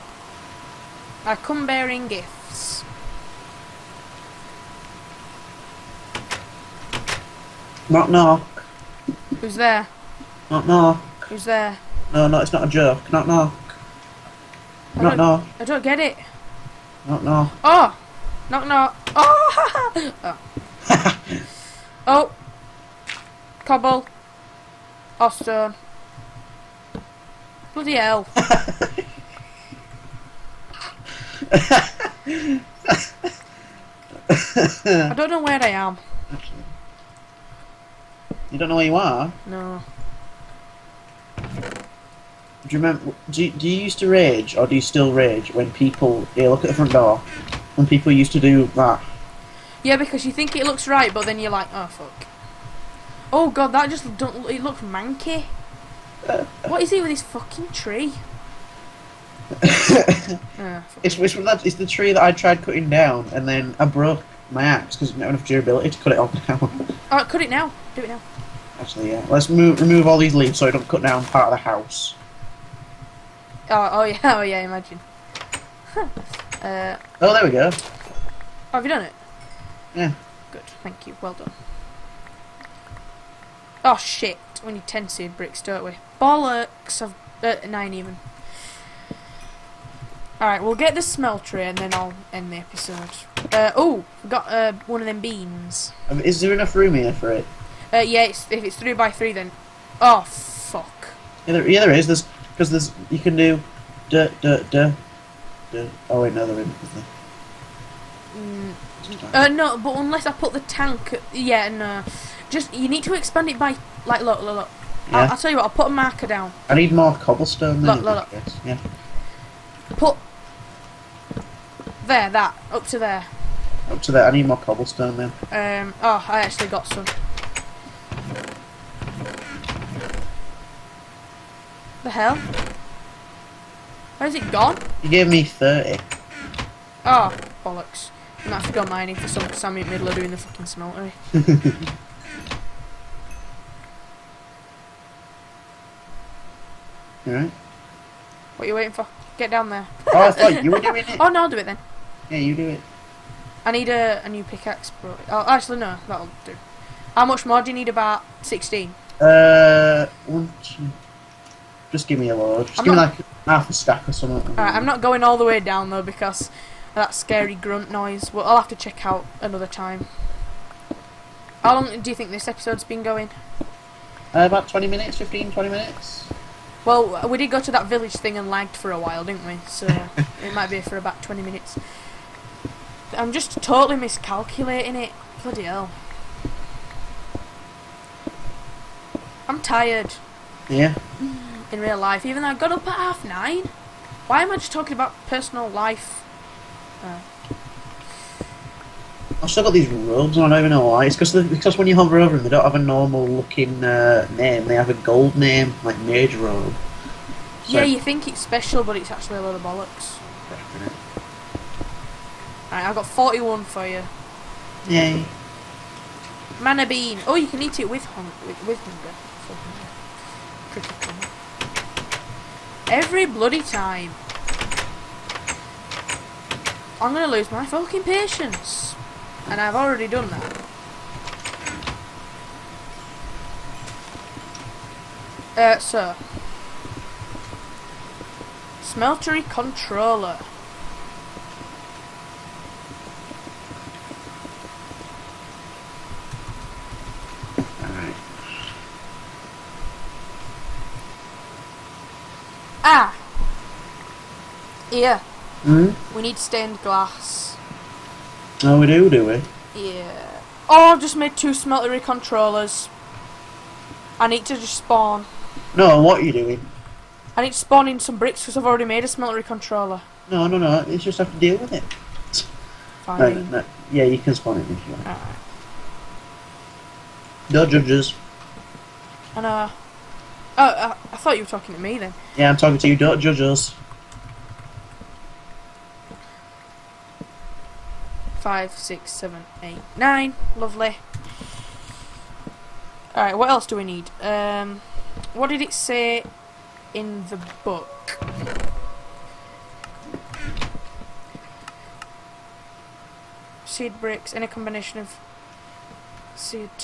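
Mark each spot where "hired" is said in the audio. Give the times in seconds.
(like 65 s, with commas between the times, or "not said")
not said.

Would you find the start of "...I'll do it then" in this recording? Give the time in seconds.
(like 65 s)
151 s.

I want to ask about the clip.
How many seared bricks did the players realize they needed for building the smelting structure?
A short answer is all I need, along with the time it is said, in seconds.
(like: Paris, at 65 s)
10, at 84 s.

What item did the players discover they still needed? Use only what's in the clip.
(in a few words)
stained glass.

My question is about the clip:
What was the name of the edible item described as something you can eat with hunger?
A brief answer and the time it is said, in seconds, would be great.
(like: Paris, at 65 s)
Mana bean, at 216 s.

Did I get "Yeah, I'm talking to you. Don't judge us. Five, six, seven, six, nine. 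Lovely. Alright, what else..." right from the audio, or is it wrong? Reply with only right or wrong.
wrong.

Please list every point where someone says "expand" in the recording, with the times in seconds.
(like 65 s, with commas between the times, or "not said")
113 s.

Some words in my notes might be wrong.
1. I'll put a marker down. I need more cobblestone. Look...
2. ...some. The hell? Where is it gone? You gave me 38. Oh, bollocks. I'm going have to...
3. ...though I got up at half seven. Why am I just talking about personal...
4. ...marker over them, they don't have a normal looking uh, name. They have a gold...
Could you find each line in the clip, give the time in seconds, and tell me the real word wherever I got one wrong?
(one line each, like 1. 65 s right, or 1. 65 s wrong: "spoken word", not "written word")
1. 115 s right
2. 126 s wrong: "30", not "38"
3. 192 s wrong: "nine", not "seven"
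4. 201 s wrong: "hover", not "marker".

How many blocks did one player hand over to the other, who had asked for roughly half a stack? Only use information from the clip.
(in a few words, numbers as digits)
41.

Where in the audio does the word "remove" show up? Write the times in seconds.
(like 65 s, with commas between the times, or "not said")
69 s.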